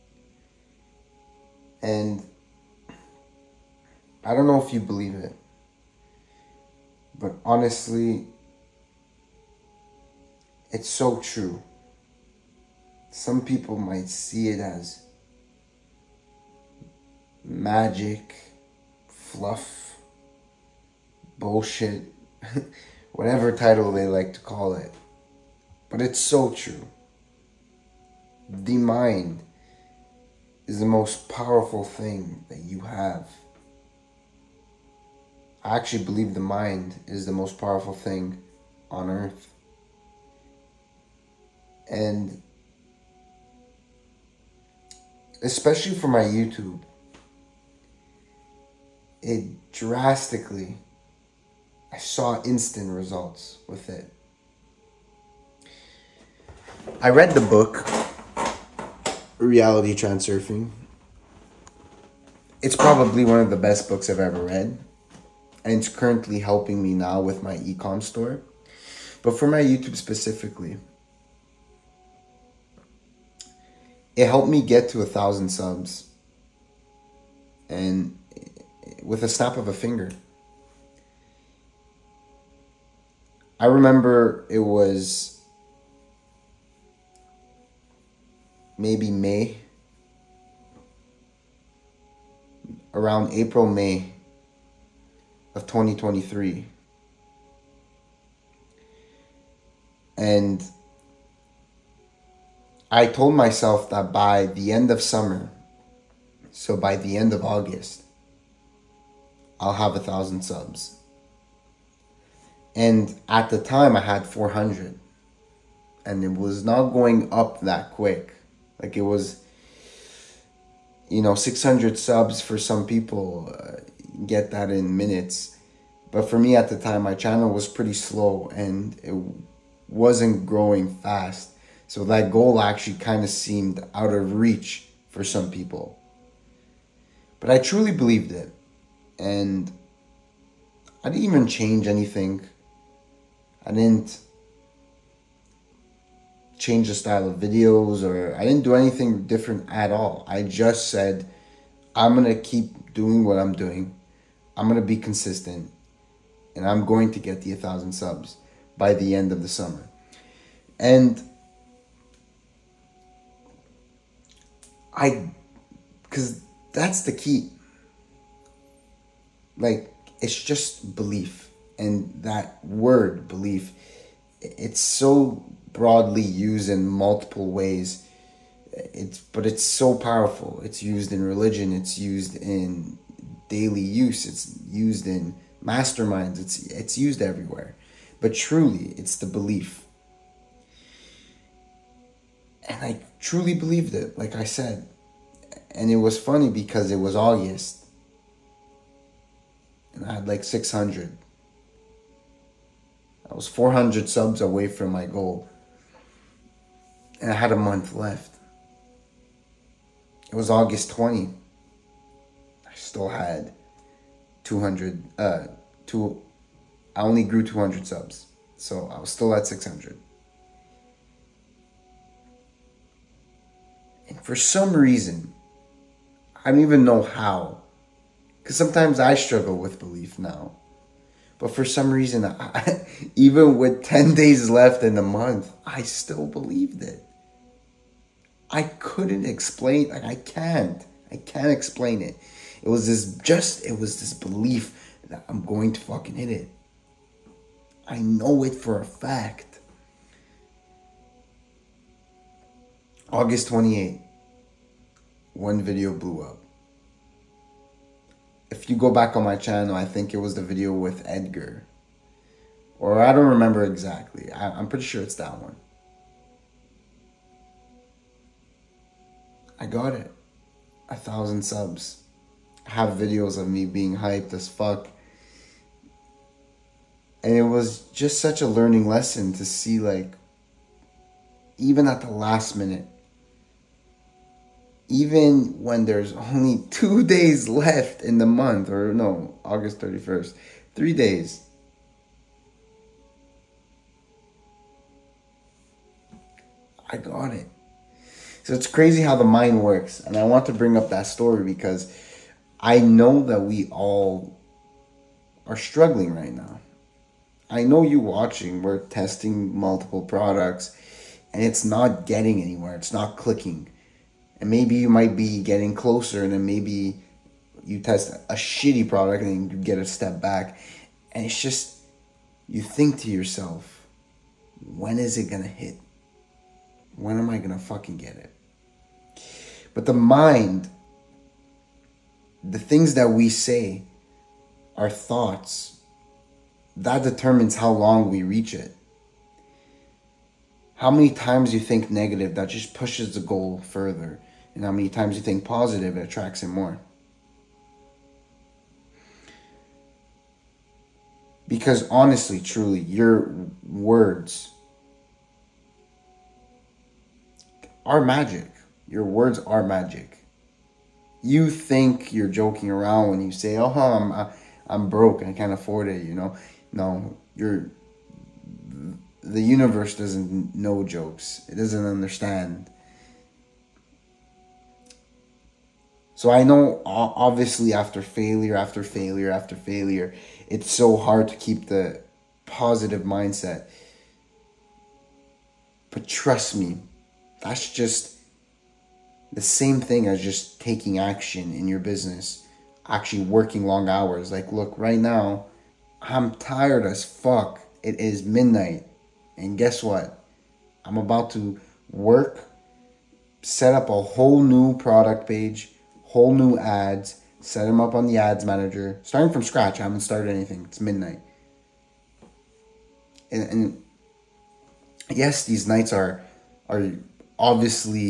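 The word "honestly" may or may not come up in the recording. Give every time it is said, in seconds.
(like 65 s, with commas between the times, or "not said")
7 s, 351 s.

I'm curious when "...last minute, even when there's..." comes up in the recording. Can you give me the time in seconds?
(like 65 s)
282 s.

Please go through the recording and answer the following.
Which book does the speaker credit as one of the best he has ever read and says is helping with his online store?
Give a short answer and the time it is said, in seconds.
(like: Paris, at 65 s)
Reality Transurfing, at 59 s.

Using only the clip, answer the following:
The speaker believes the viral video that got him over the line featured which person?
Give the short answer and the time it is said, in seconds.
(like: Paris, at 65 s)
Edgar, at 261 s.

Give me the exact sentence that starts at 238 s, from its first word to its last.
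I couldn't explain, like, I can't.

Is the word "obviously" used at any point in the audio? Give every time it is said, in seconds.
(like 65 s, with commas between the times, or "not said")
376 s, 417 s.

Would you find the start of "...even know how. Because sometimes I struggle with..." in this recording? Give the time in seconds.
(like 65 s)
226 s.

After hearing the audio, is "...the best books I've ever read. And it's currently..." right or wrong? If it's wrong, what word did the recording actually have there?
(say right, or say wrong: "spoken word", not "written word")
right.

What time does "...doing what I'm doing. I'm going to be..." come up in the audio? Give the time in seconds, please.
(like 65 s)
152 s.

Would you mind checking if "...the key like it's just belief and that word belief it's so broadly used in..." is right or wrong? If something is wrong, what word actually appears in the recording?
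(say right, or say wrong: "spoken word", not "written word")
right.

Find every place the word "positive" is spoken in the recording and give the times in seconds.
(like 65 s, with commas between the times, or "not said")
345 s, 382 s.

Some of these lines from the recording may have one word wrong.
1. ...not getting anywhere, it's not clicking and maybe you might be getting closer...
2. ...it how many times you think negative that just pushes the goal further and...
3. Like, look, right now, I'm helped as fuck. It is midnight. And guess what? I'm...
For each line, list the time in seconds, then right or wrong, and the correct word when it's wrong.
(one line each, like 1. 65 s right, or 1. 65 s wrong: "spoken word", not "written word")
1. 311 s right
2. 338 s right
3. 394 s wrong: "tired", not "helped".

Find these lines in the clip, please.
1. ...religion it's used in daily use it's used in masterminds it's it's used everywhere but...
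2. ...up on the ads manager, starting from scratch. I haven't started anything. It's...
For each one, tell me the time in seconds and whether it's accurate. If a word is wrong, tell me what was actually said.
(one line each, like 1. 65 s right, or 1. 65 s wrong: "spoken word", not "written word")
1. 181 s right
2. 407 s right.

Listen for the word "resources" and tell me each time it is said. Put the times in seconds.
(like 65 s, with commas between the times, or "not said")
not said.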